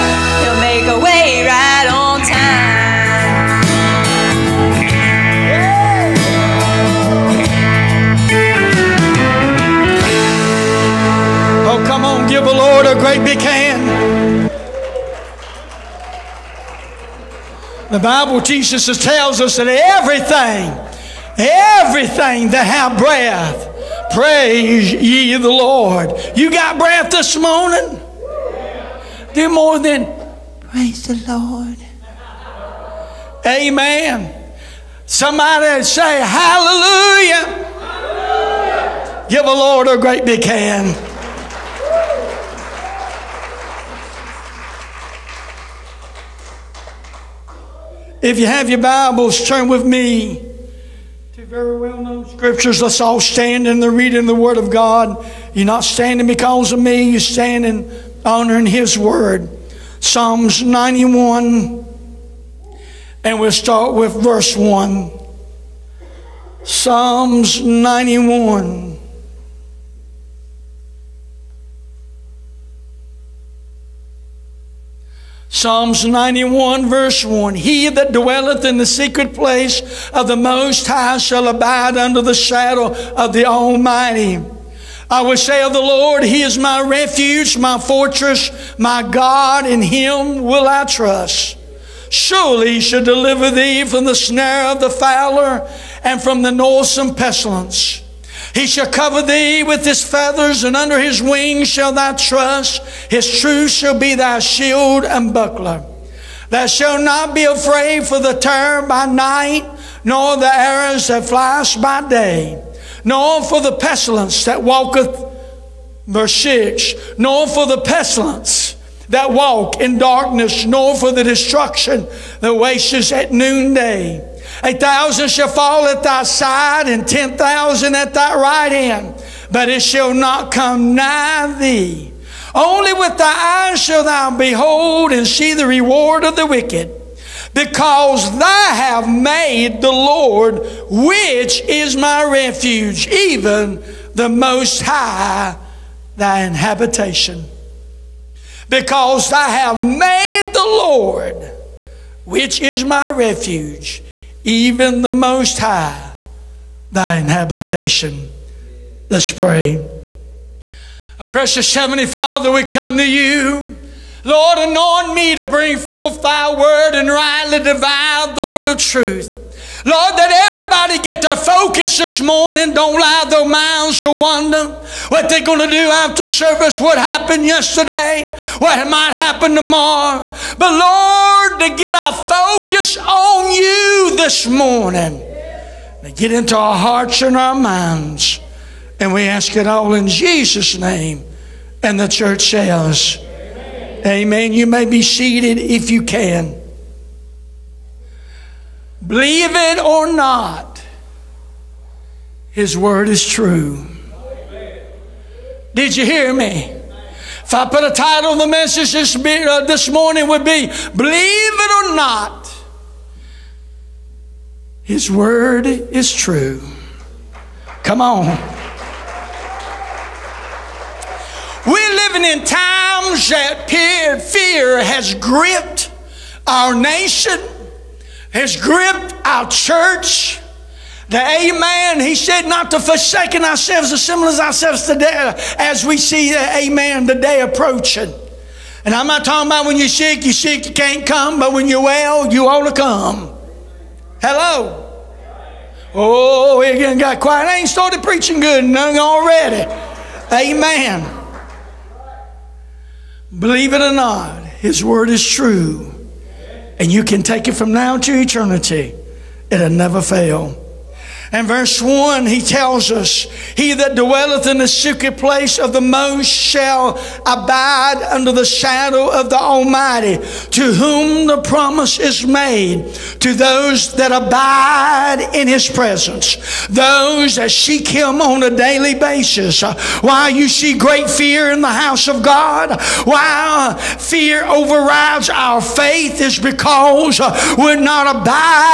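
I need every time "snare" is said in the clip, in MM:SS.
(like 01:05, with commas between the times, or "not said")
01:34.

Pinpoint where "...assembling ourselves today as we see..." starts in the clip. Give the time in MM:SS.
03:53.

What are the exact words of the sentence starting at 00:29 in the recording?
they more than praise the Lord.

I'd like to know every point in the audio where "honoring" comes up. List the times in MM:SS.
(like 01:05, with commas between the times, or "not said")
00:58.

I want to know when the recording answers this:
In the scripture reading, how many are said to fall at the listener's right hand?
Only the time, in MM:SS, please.
02:07.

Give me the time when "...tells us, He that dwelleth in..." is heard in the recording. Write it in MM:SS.
04:22.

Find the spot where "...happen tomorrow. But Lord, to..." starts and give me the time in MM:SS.
02:59.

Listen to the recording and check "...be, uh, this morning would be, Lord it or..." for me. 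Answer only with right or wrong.
wrong.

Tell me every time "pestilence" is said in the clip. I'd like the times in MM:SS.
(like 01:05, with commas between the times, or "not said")
01:37, 01:53, 01:57.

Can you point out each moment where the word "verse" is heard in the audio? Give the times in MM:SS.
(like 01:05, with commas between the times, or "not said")
01:04, 01:16, 01:56, 04:21.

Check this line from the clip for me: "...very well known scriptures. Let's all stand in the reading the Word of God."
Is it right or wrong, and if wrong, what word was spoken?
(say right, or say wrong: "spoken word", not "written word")
right.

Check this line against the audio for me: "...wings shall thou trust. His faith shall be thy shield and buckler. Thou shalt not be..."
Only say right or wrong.
wrong.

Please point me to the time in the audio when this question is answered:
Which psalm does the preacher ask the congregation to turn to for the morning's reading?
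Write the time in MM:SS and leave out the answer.
00:59.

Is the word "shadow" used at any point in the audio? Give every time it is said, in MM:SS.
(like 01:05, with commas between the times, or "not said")
01:22, 04:28.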